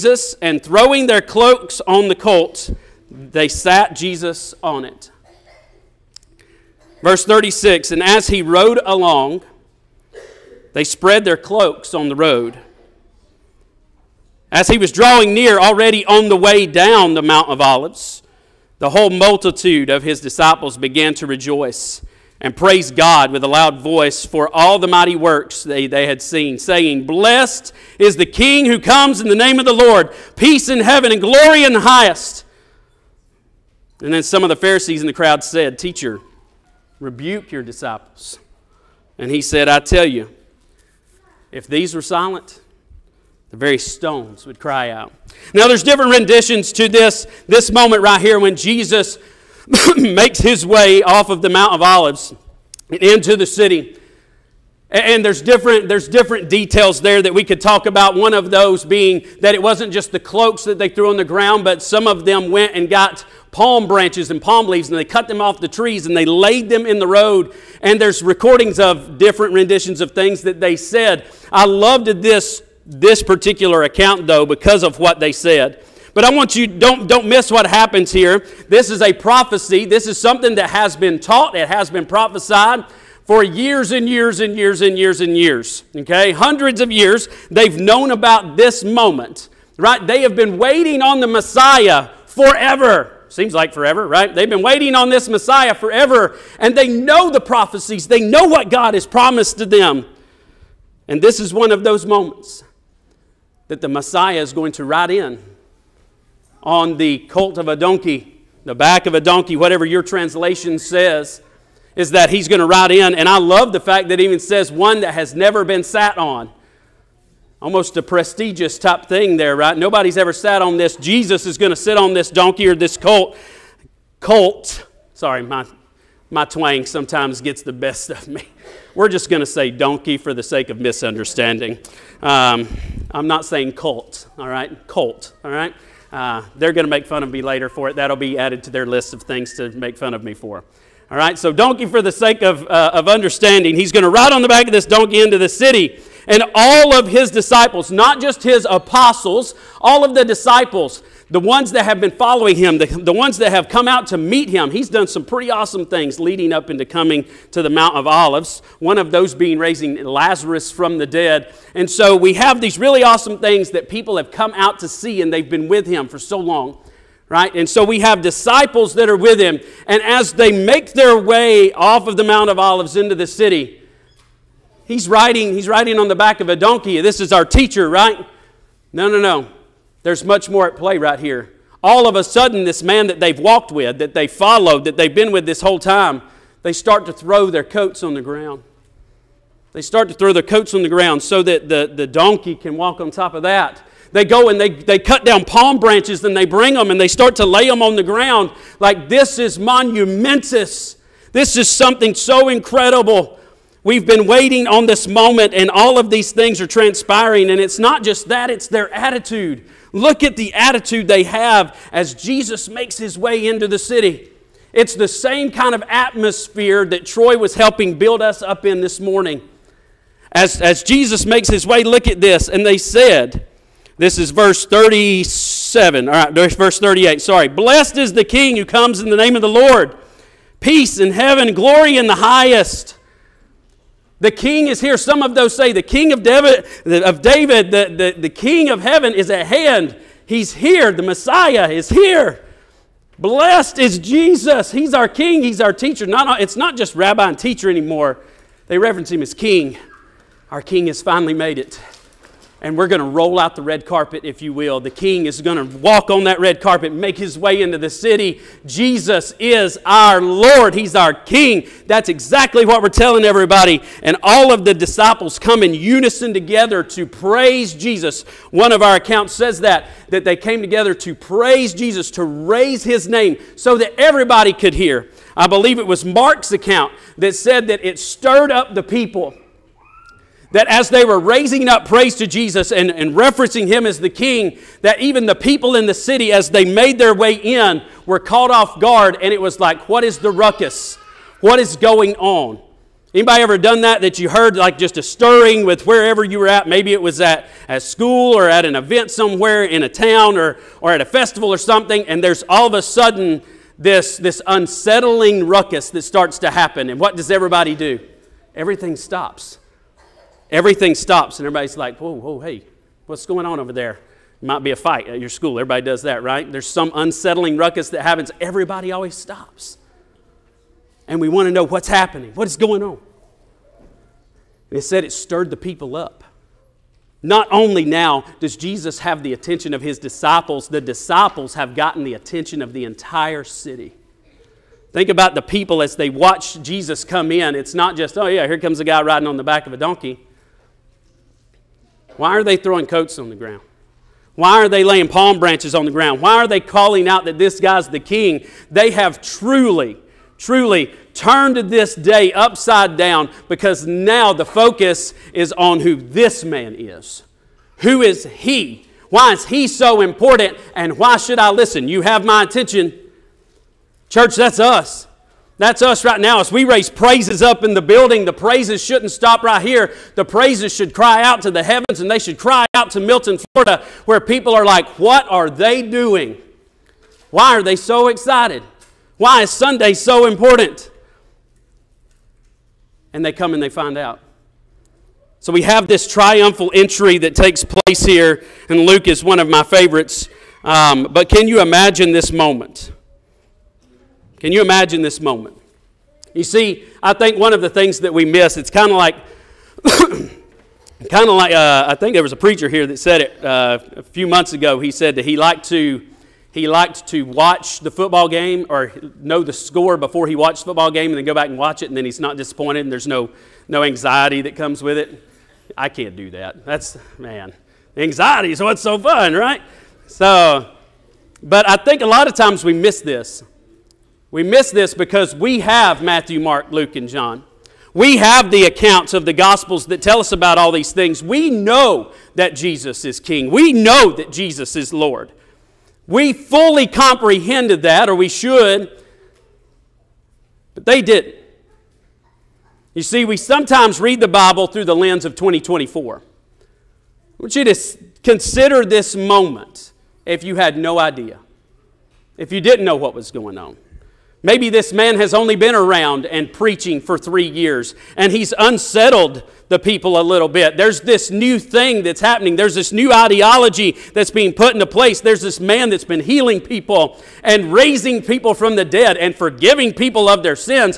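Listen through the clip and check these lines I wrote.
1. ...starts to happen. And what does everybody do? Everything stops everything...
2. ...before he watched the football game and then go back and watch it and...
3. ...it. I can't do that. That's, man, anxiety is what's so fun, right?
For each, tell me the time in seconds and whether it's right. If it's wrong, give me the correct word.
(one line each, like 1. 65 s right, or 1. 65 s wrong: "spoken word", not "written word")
1. 306 s right
2. 409 s right
3. 414 s right.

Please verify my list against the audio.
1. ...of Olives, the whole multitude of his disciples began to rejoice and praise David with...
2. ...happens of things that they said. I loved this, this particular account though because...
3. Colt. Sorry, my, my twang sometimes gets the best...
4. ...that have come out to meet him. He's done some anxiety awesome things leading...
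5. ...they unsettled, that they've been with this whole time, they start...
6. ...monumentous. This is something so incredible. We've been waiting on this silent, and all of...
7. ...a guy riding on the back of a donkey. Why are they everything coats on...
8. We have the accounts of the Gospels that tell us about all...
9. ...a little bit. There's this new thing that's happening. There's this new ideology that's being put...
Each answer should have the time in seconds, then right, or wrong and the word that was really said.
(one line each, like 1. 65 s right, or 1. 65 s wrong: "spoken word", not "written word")
1. 17 s wrong: "God", not "David"
2. 69 s wrong: "renditions", not "happens"
3. 124 s right
4. 153 s wrong: "pretty", not "anxiety"
5. 184 s wrong: "followed", not "unsettled"
6. 199 s wrong: "moment", not "silent"
7. 338 s wrong: "throwing", not "everything"
8. 427 s right
9. 460 s right.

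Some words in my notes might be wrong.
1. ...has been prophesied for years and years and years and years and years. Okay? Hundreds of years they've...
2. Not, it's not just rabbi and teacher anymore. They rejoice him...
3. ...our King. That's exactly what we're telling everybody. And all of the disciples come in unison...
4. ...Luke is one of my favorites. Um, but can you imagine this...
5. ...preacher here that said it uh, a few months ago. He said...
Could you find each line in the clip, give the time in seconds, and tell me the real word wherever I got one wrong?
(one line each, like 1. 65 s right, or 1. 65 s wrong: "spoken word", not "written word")
1. 81 s right
2. 246 s wrong: "reference", not "rejoice"
3. 260 s right
4. 388 s right
5. 402 s right.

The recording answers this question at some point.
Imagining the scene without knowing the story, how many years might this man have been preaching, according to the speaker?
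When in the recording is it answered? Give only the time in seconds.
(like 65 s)
457 s.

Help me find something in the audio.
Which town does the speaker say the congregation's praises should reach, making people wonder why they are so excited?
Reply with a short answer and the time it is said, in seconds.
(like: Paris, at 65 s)
Milton, Florida, at 372 s.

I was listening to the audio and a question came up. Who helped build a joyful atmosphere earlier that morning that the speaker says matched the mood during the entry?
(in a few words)
Troy.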